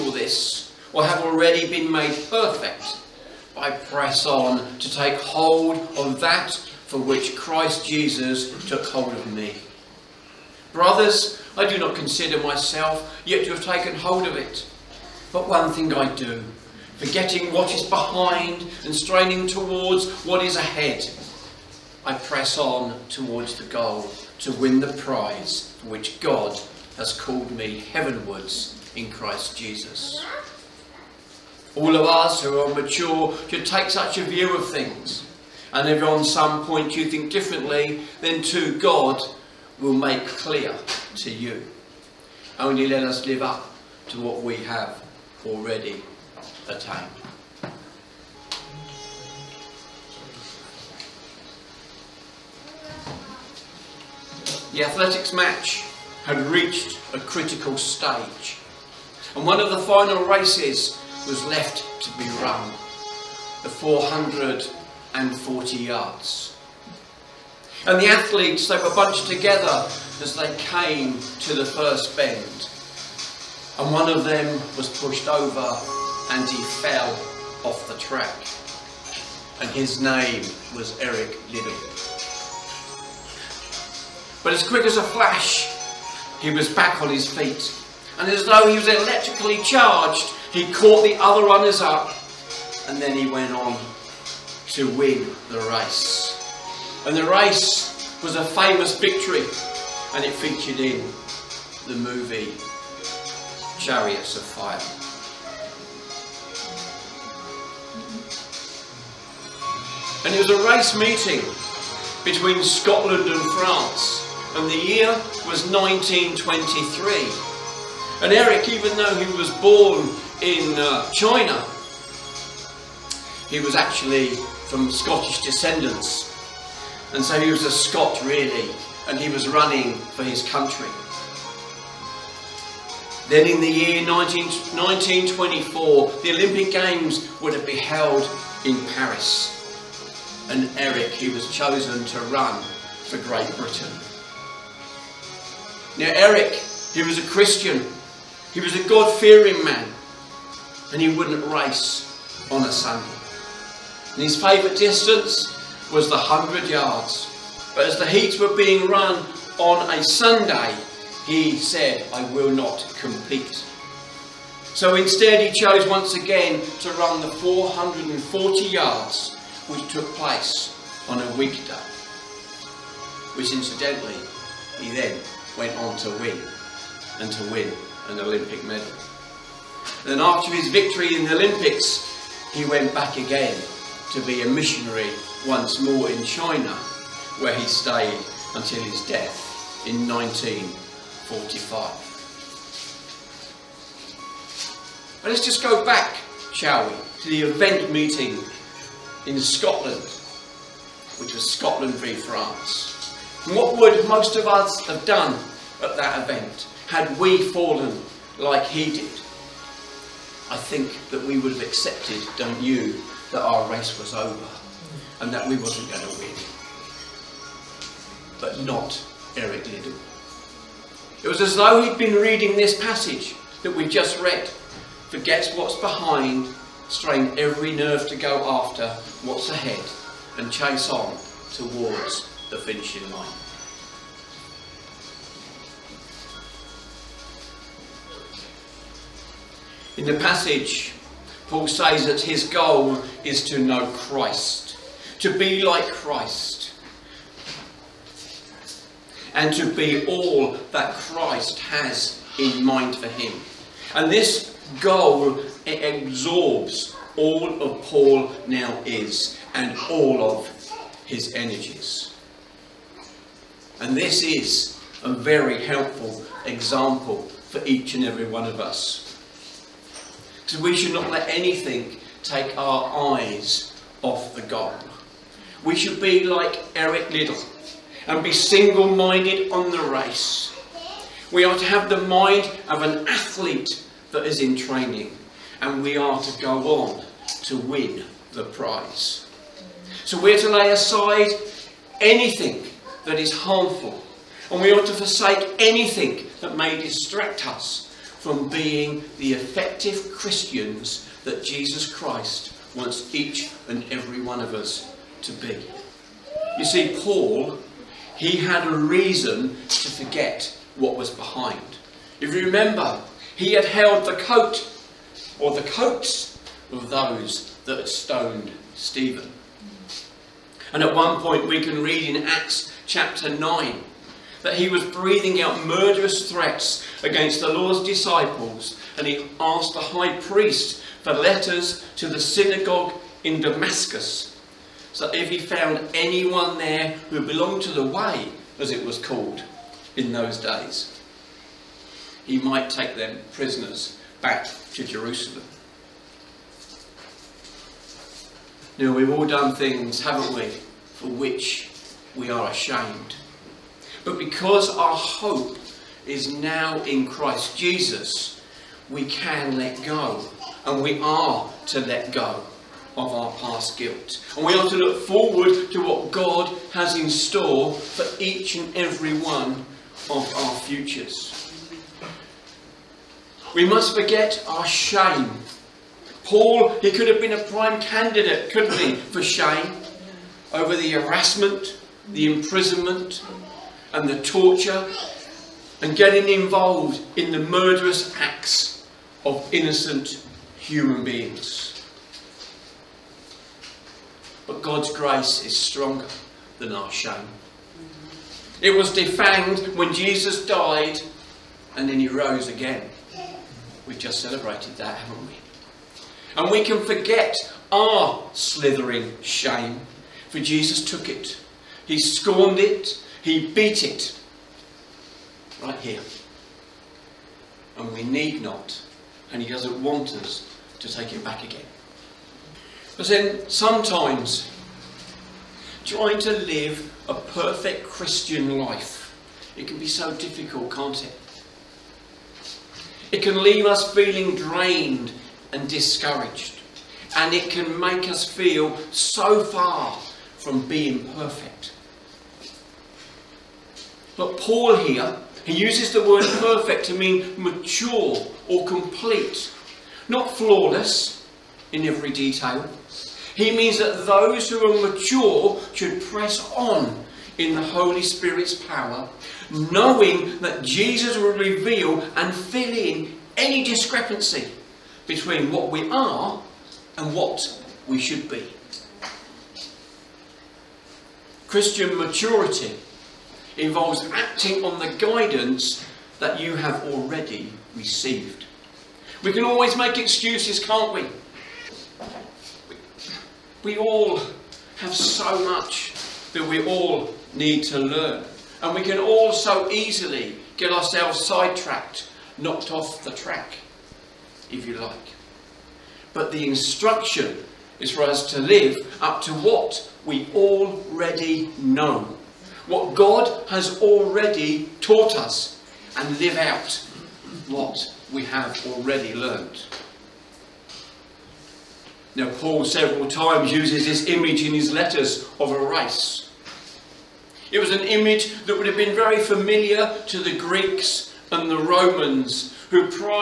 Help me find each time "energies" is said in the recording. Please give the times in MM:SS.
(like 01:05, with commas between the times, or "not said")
04:21.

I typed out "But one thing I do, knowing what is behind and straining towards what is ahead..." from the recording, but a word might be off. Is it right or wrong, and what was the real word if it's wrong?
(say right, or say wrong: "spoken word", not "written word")
wrong: "forgetting", not "knowing".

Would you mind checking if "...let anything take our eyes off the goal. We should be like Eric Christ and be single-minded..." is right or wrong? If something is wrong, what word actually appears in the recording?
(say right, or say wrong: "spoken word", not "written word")
wrong: "Liddell", not "Christ".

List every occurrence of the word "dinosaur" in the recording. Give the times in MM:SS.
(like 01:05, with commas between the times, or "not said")
not said.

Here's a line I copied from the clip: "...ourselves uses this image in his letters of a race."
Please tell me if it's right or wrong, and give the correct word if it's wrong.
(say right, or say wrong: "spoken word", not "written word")
wrong: "times", not "ourselves".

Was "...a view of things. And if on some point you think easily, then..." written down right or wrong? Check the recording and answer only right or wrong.
wrong.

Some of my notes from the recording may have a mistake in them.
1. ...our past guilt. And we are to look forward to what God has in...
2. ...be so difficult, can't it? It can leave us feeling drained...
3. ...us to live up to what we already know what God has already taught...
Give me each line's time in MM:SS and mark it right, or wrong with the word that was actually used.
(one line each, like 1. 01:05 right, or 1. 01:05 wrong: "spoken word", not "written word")
1. 06:03 right
2. 07:09 right
3. 08:18 right.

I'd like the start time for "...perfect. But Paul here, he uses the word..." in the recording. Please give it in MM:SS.
07:21.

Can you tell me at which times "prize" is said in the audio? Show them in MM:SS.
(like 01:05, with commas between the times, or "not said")
00:24, 04:48.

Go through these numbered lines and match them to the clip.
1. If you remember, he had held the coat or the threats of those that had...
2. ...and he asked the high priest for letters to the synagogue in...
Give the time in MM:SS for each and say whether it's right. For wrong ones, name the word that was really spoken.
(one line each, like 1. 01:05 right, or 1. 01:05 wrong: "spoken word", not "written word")
1. 05:12 wrong: "coats", not "threats"
2. 05:28 right.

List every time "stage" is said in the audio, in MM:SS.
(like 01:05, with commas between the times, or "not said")
00:57.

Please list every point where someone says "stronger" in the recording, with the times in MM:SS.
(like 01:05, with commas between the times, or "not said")
06:35.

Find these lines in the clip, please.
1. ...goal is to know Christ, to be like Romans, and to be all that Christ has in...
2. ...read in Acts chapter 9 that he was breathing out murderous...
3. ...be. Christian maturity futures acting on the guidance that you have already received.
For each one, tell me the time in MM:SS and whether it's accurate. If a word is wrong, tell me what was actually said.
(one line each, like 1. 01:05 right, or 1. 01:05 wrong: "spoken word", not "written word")
1. 04:02 wrong: "Christ", not "Romans"
2. 05:21 right
3. 07:48 wrong: "involves", not "futures".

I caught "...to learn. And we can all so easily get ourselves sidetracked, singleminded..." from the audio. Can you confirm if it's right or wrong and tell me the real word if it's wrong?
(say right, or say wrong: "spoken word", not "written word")
wrong: "knocked", not "singleminded".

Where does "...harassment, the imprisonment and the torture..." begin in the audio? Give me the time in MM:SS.
06:20.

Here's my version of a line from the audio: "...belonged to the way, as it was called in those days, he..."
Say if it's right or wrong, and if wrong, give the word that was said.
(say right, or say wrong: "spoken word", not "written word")
right.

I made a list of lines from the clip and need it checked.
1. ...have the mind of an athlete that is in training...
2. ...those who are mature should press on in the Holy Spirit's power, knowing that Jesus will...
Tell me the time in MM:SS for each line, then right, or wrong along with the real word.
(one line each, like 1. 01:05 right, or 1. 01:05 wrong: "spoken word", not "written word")
1. 04:41 right
2. 07:34 right.